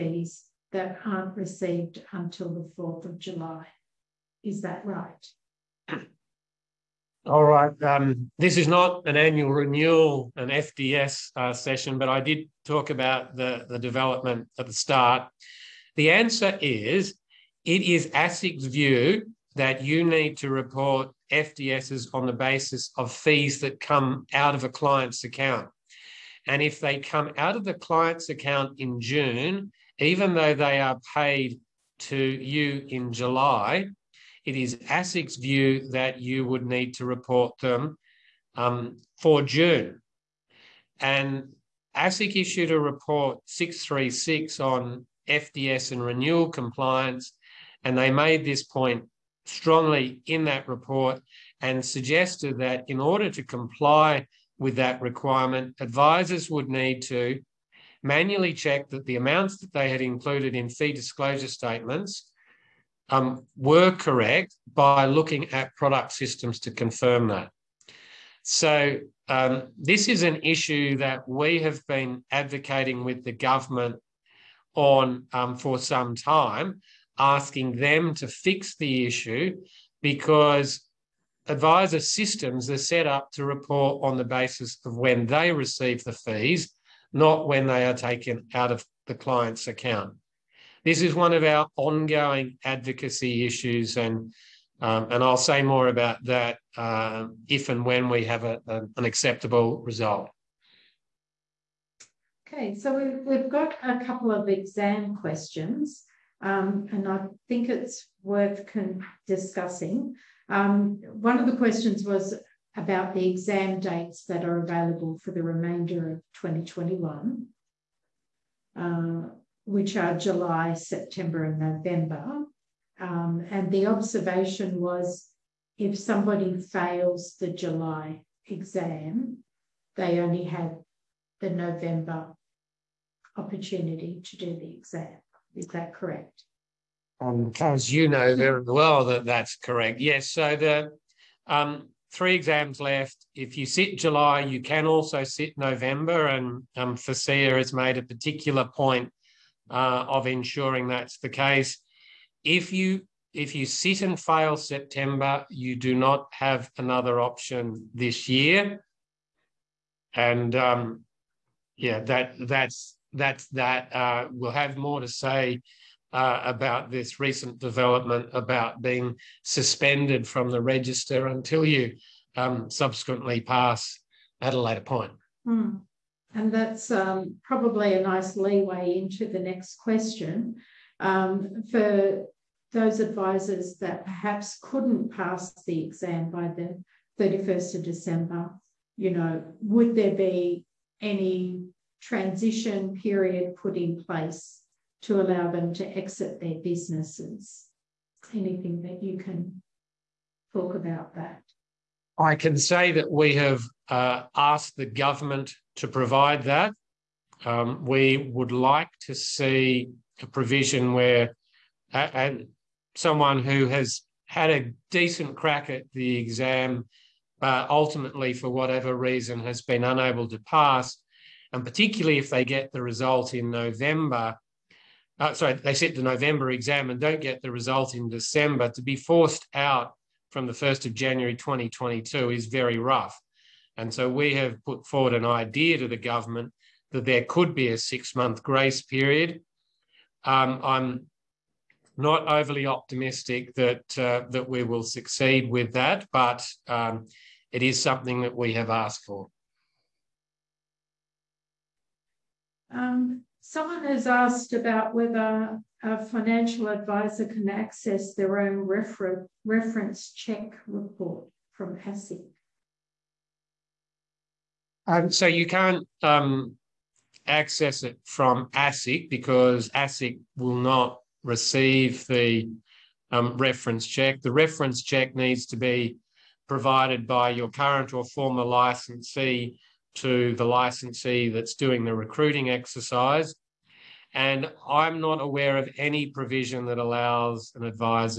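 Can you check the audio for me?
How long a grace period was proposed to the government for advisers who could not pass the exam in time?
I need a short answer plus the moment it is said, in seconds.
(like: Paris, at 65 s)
six month, at 237 s.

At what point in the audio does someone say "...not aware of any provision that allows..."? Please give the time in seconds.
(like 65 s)
285 s.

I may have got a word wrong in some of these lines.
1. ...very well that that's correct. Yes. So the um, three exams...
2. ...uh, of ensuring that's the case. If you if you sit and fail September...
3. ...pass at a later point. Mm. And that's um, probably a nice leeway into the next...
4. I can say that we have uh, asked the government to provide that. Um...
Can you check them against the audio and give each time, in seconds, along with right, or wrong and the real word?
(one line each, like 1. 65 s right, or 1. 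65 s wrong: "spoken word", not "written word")
1. 138 s right
2. 149 s right
3. 173 s right
4. 202 s right.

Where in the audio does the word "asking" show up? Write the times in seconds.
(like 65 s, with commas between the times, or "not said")
77 s.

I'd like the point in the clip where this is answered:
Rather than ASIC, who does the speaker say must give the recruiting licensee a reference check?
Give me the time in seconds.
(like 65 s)
277 s.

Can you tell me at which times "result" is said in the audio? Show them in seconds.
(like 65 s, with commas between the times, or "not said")
99 s, 222 s, 227 s.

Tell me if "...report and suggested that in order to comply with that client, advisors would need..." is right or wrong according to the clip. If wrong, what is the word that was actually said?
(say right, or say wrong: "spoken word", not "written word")
wrong: "requirement", not "client".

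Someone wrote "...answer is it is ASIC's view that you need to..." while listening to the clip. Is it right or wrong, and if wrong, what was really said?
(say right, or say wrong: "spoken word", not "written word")
right.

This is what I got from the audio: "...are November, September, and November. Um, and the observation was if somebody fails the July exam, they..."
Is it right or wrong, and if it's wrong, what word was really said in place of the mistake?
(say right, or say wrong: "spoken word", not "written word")
wrong: "July", not "November".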